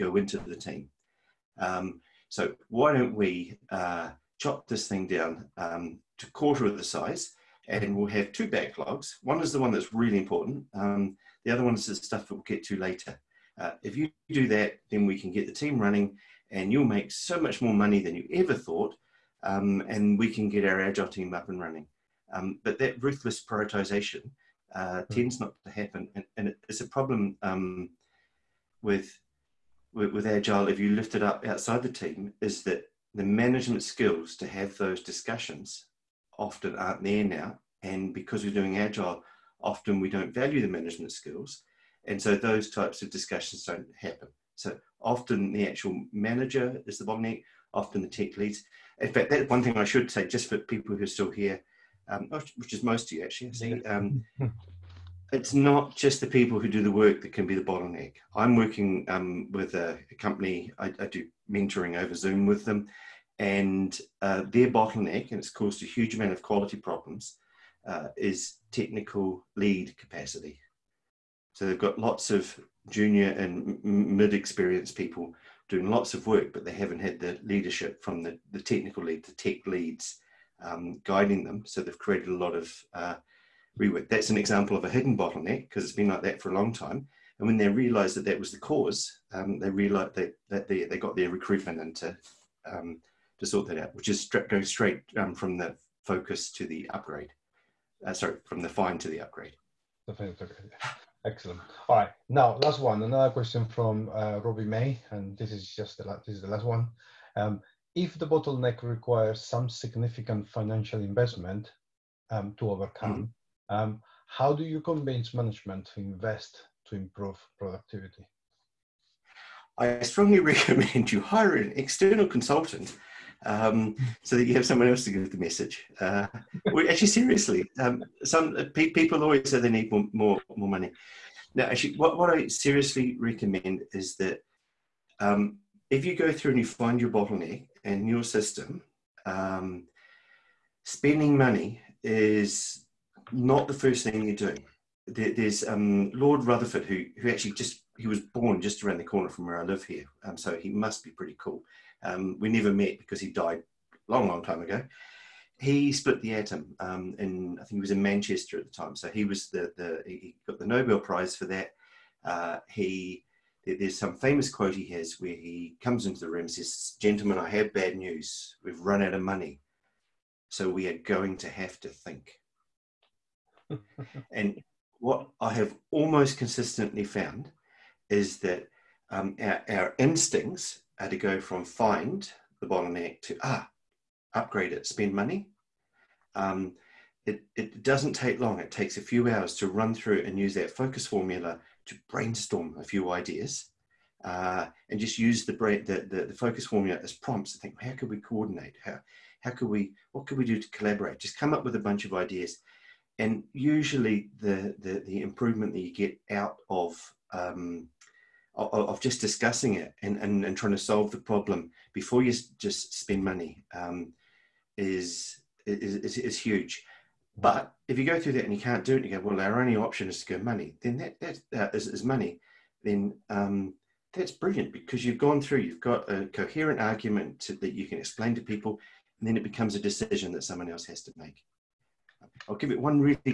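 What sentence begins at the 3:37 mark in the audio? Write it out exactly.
But if you go through that and you can't do it, you go, well, our only option is to go money.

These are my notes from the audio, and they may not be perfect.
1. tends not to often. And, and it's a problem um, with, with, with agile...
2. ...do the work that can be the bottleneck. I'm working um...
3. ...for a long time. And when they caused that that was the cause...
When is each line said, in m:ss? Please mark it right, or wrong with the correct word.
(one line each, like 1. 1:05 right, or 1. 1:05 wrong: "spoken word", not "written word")
1. 0:25 wrong: "happen", not "often"
2. 0:56 right
3. 1:26 wrong: "realized", not "caused".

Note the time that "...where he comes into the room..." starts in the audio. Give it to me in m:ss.
2:45.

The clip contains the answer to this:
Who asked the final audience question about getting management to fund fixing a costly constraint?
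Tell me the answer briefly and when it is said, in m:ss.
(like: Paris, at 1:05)
Robbie May, at 1:44.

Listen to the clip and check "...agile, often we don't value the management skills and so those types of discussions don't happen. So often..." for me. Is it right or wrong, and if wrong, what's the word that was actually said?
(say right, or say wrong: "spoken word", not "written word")
right.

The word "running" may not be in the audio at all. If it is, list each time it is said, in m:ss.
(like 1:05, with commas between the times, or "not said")
0:15, 0:21.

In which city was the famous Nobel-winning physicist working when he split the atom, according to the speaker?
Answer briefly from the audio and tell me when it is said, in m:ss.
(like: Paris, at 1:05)
Manchester, at 2:38.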